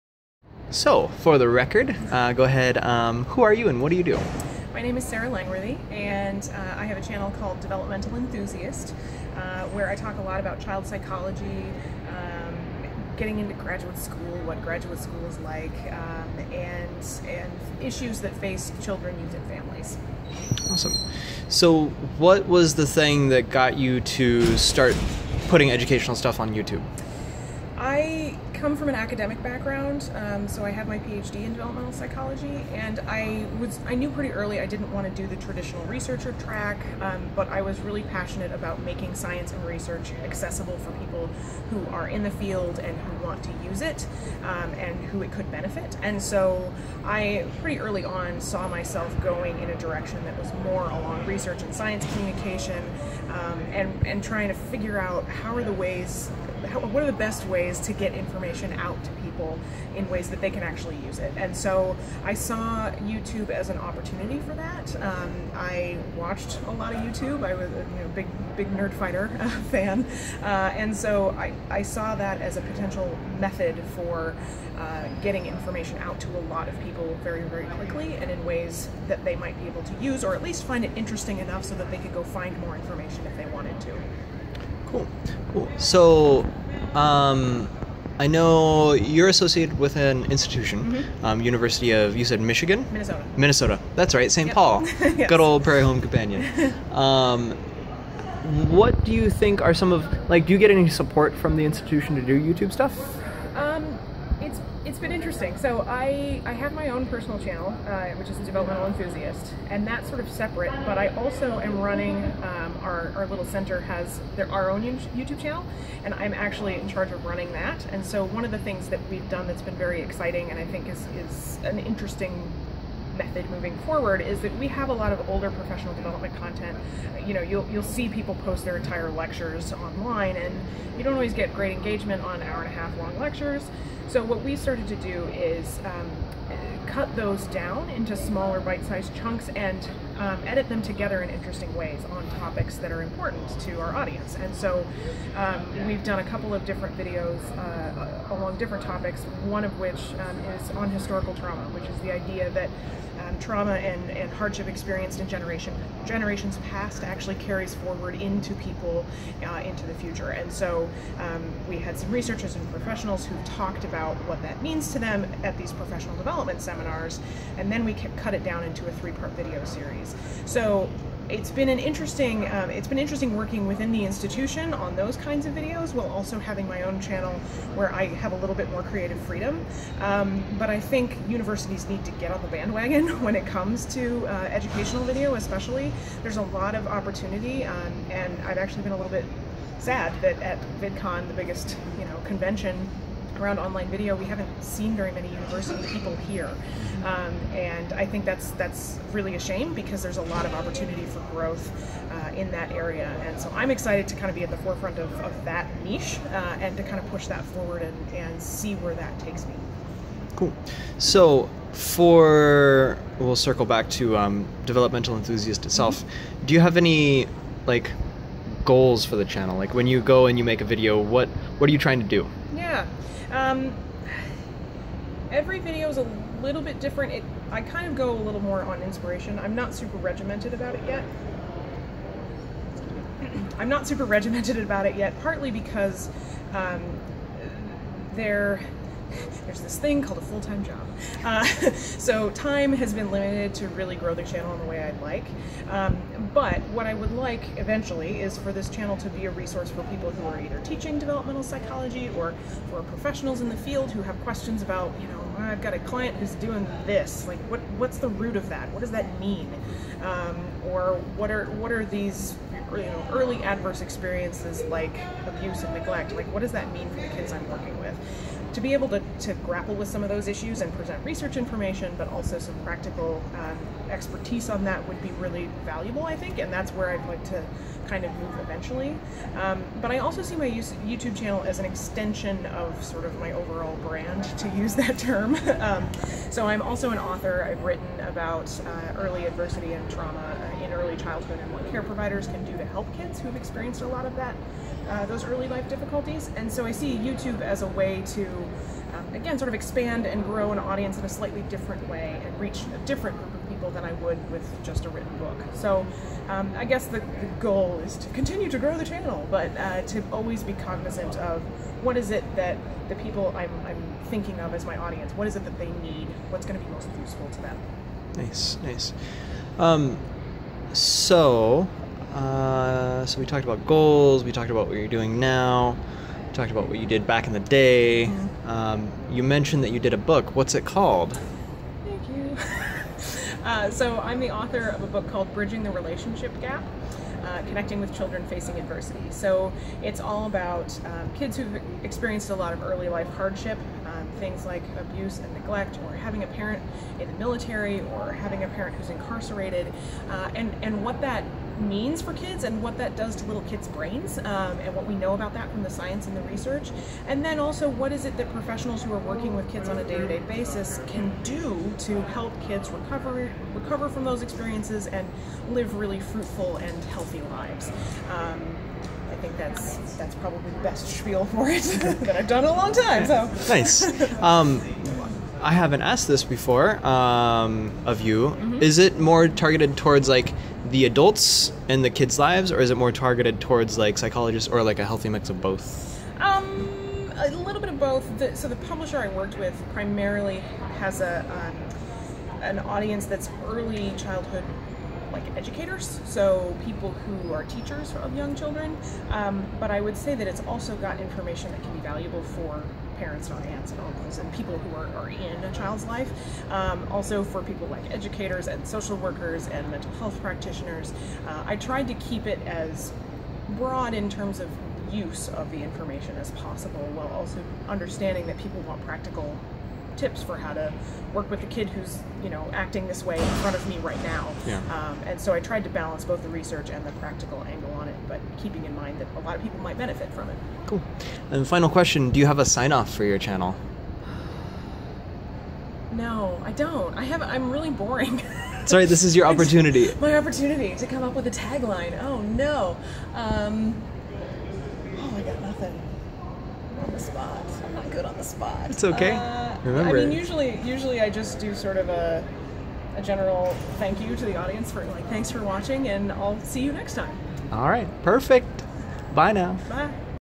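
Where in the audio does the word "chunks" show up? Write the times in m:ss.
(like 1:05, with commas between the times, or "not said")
2:19.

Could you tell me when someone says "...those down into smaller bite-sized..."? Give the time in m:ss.
2:17.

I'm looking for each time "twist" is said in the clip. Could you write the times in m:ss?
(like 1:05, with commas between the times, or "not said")
not said.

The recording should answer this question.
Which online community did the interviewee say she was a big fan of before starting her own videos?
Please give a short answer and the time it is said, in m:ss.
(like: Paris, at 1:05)
Nerdfighter, at 1:08.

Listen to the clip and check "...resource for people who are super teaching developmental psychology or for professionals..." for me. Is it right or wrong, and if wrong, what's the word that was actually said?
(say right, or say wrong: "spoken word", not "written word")
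wrong: "either", not "super".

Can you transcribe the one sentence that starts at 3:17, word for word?
Um, and I think that's, that's really a shame because there's a lot of opportunity for growth uh, in that area.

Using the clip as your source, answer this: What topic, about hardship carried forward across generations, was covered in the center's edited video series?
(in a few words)
historical trauma.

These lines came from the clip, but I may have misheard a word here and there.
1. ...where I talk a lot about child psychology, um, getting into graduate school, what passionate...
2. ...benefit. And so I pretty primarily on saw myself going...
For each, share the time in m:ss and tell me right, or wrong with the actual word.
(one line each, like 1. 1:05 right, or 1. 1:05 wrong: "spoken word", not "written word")
1. 0:09 wrong: "graduate", not "passionate"
2. 0:45 wrong: "early", not "primarily".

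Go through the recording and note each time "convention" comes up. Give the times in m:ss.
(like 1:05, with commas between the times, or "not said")
3:12.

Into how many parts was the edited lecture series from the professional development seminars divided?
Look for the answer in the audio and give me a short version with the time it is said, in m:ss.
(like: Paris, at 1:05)
3, at 2:48.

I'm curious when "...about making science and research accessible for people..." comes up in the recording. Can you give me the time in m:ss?
0:38.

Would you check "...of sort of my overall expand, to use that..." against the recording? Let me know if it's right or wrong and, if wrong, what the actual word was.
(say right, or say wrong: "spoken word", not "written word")
wrong: "brand", not "expand".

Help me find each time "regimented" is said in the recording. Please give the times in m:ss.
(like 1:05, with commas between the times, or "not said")
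3:49, 3:54.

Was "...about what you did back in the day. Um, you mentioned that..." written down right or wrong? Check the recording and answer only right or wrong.
right.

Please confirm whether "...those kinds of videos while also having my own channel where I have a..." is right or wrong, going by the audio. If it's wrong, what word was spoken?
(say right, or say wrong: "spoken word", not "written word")
right.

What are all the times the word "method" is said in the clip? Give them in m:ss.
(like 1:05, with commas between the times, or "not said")
1:13, 2:03.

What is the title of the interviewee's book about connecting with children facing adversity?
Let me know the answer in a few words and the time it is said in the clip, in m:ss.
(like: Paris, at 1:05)
Bridging the Relationship Gap, at 5:35.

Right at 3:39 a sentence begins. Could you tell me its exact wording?
Like when you go and you make a video, what what are you trying to do?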